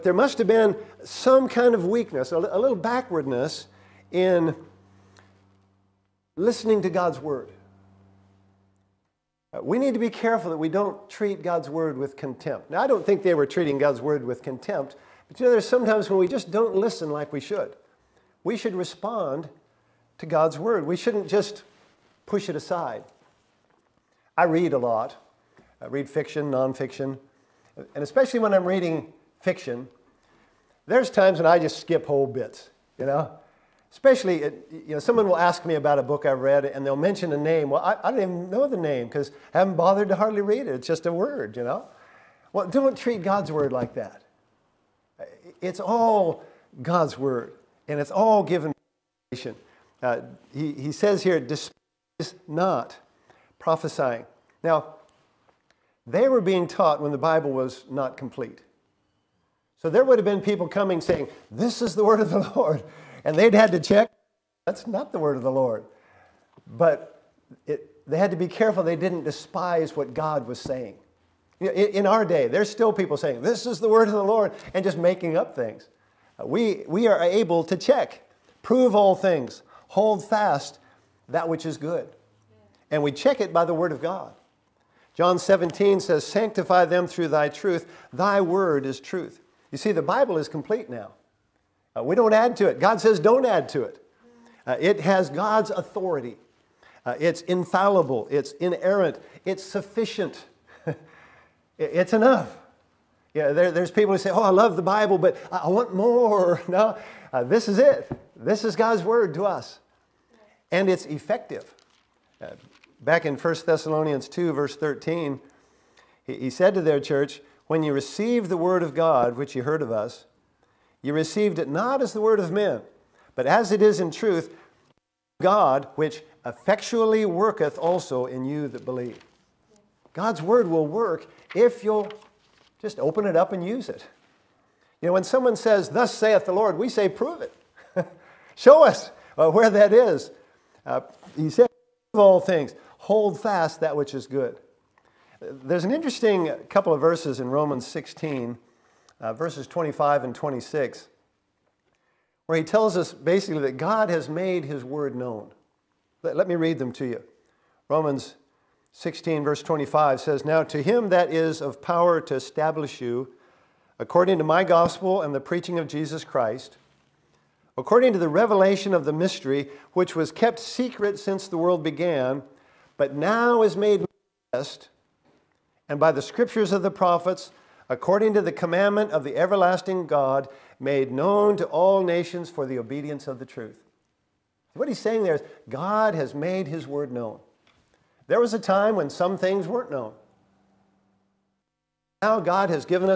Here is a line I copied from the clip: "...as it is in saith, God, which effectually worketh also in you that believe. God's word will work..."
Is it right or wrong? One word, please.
wrong.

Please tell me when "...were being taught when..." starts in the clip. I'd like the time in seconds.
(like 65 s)
56 s.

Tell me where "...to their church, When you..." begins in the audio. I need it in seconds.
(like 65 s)
116 s.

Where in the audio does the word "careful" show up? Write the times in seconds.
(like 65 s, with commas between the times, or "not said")
10 s, 68 s.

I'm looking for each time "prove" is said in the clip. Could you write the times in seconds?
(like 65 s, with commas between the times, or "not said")
78 s, 137 s, 142 s.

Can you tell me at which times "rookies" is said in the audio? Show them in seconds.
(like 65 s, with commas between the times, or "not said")
not said.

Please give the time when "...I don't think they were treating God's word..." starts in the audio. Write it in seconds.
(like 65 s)
12 s.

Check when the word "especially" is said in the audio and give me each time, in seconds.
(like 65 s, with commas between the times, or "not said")
28 s, 33 s.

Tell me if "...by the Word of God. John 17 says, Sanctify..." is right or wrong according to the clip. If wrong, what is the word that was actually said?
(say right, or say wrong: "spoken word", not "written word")
right.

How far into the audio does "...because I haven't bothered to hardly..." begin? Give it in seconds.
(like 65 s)
39 s.